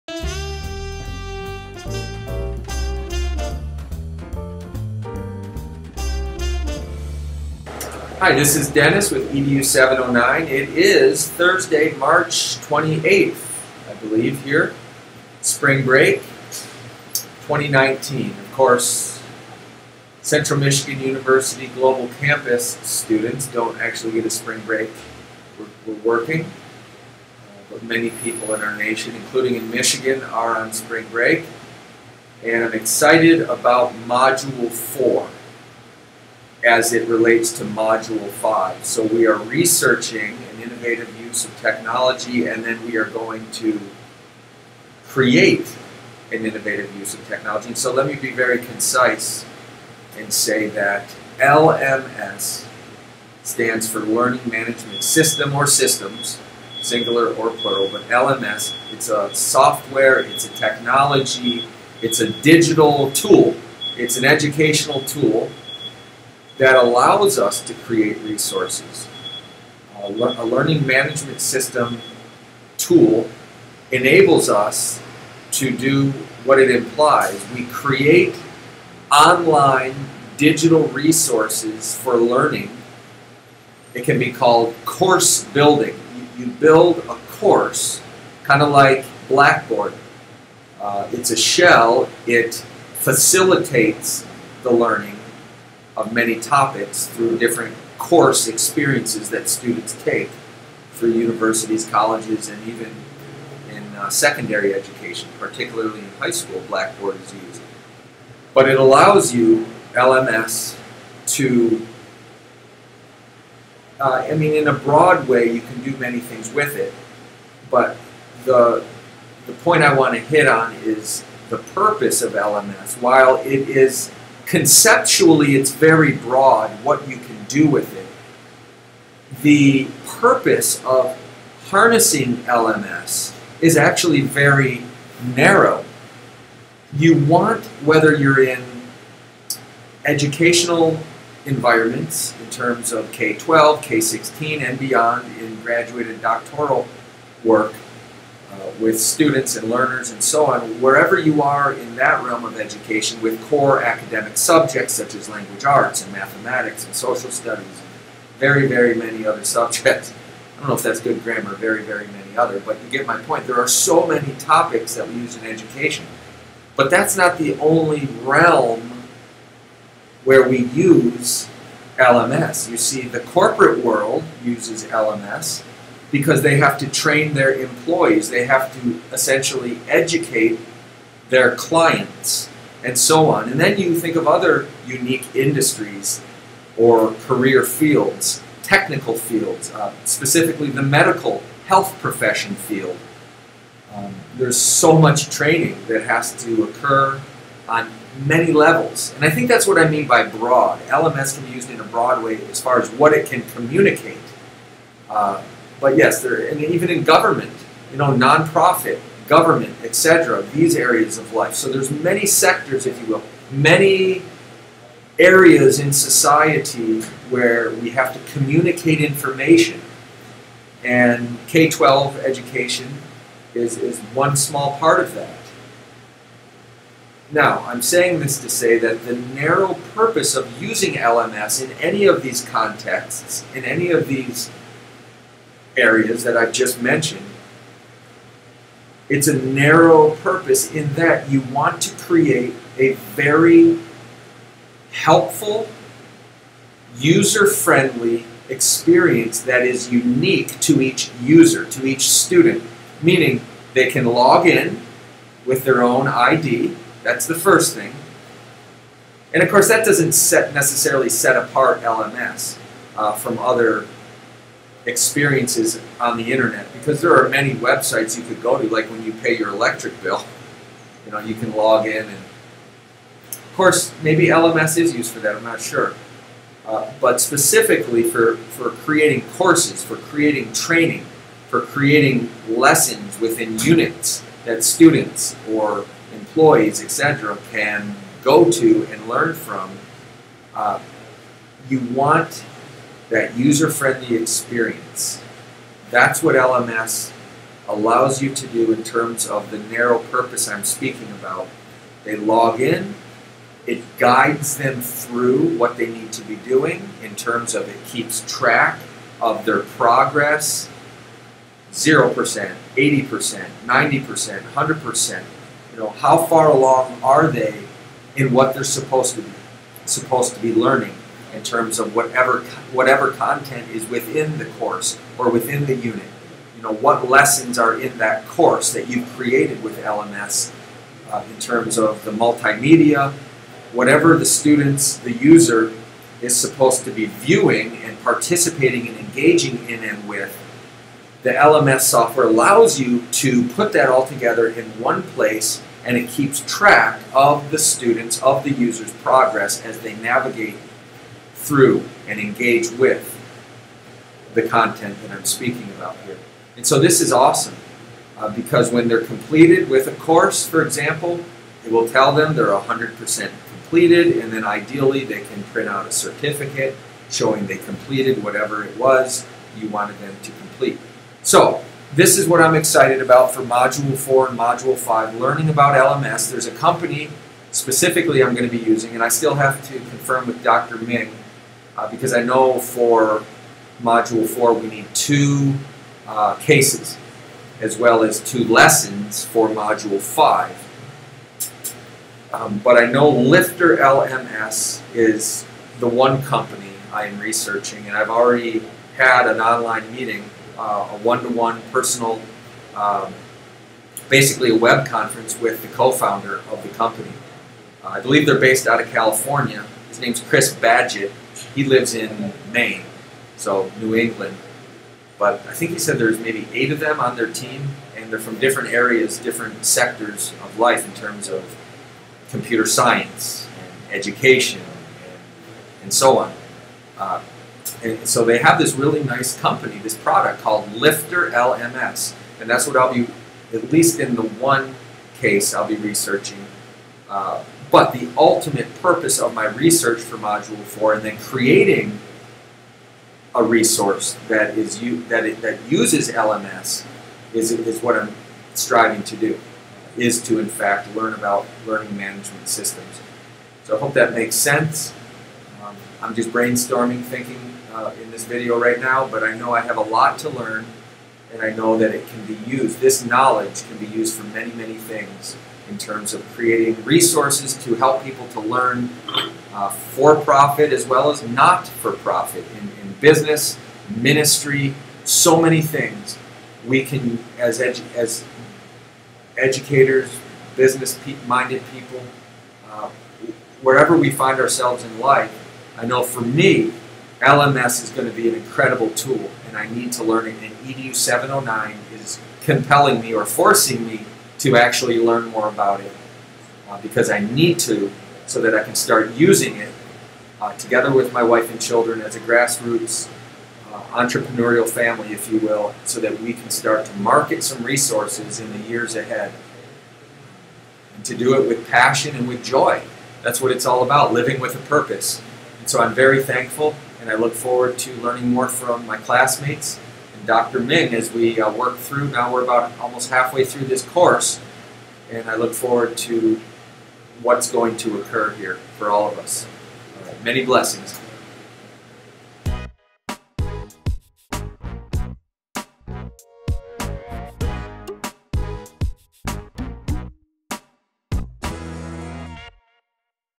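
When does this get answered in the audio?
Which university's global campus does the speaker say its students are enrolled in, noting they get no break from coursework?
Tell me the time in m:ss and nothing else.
0:20.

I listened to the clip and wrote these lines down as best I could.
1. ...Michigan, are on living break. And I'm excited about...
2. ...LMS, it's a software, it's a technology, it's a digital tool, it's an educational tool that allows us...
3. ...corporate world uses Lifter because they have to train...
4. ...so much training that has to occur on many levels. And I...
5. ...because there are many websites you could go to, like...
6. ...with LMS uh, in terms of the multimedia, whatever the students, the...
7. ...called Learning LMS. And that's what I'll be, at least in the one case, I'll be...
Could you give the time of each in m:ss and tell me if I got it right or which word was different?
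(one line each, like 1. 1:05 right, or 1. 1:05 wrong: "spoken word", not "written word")
1. 0:29 wrong: "spring", not "living"
2. 0:58 right
3. 2:53 wrong: "LMS", not "Lifter"
4. 3:14 right
5. 4:26 right
6. 5:29 right
7. 7:10 wrong: "Lifter", not "Learning".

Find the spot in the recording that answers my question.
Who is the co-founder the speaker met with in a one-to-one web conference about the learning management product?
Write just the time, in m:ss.
6:50.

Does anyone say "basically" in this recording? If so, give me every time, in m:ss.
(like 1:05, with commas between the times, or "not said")
6:44.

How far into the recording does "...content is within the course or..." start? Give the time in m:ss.
5:23.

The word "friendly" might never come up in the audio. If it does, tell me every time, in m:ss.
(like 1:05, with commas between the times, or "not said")
4:07, 4:53.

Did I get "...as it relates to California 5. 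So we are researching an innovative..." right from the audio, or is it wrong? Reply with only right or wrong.
wrong.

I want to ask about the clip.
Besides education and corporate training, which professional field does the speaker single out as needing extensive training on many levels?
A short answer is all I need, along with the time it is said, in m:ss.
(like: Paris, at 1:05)
medical health profession, at 3:10.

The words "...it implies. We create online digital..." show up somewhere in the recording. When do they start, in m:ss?
1:16.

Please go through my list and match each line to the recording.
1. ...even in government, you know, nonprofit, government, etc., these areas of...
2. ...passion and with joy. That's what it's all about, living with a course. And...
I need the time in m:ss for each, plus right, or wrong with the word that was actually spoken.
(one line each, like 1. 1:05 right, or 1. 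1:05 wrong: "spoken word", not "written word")
1. 3:26 right
2. 8:31 wrong: "purpose", not "course".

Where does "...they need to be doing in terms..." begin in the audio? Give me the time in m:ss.
5:05.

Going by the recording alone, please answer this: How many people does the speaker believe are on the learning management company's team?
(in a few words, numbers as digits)
8.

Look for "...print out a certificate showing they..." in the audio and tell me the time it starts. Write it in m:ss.
6:05.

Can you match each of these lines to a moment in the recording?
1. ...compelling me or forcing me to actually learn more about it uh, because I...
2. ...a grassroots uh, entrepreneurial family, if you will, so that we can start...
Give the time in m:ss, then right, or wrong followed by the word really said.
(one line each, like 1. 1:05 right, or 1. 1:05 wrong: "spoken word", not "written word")
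1. 8:12 right
2. 8:22 right.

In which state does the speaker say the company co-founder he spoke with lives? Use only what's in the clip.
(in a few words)
Maine.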